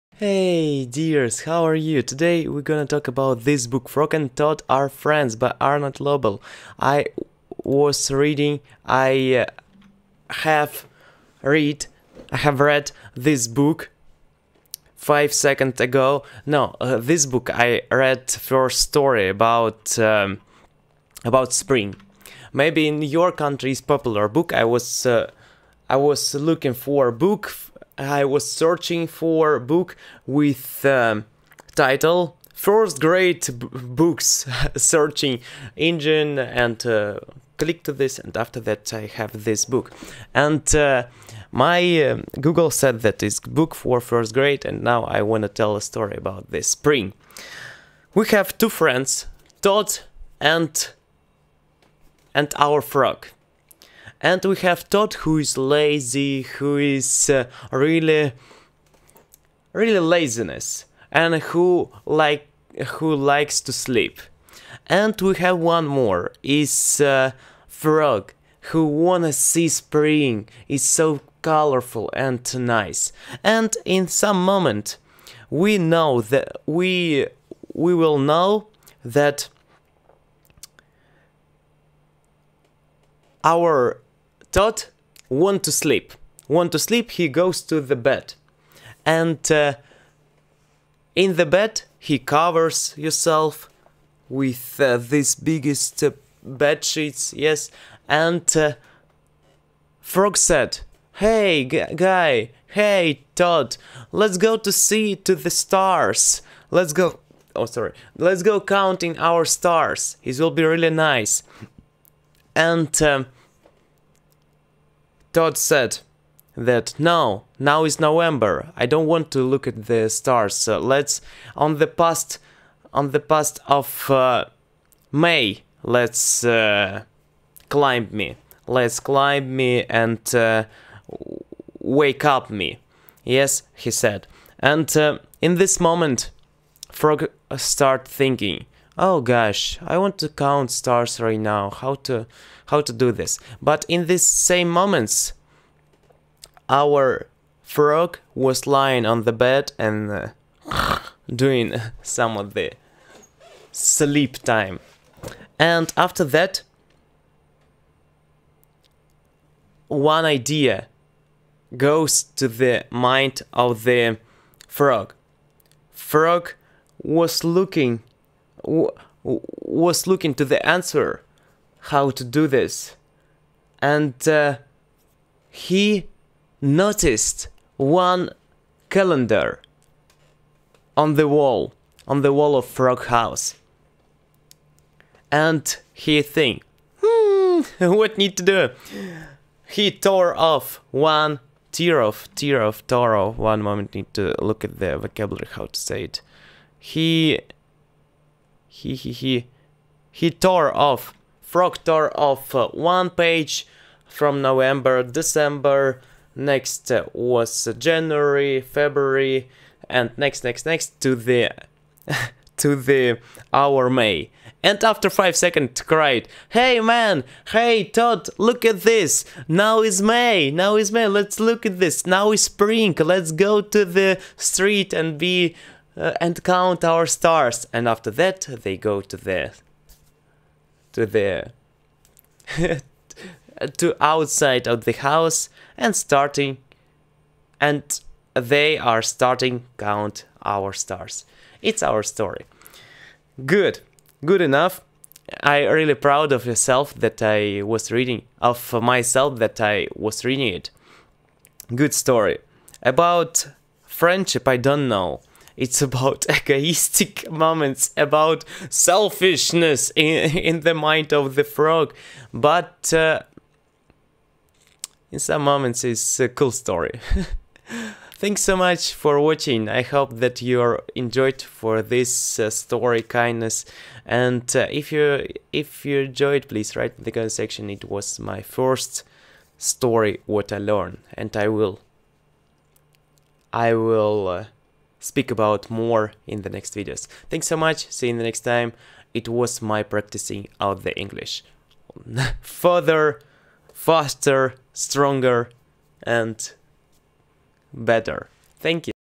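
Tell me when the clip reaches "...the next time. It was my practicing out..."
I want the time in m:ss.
4:48.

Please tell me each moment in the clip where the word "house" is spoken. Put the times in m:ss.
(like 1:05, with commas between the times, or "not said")
3:03, 3:54.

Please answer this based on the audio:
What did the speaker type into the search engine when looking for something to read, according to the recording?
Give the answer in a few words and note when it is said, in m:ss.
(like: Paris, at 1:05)
first grade books, at 0:32.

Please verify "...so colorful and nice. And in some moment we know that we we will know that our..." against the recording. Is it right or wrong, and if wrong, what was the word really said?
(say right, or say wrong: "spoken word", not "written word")
right.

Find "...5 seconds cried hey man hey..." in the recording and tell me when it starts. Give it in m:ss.
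3:35.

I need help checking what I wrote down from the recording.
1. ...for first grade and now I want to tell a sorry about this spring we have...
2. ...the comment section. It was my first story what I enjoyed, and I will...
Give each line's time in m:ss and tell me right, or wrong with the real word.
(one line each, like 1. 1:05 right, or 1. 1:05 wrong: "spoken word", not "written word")
1. 0:43 wrong: "story", not "sorry"
2. 4:37 wrong: "learned", not "enjoyed".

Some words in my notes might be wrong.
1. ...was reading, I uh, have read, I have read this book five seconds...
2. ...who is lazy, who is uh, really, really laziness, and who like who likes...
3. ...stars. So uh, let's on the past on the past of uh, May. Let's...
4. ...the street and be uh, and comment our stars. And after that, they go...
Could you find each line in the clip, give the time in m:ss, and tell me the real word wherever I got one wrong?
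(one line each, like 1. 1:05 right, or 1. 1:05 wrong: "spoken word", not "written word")
1. 0:07 right
2. 0:55 right
3. 2:00 right
4. 3:43 wrong: "count", not "comment".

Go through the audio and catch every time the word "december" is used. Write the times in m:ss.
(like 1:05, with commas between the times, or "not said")
3:25.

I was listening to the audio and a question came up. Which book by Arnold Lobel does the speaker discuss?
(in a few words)
Frog and Toad Are Friends.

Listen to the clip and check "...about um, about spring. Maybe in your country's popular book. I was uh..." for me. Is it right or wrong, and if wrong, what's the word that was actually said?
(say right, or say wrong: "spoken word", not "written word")
right.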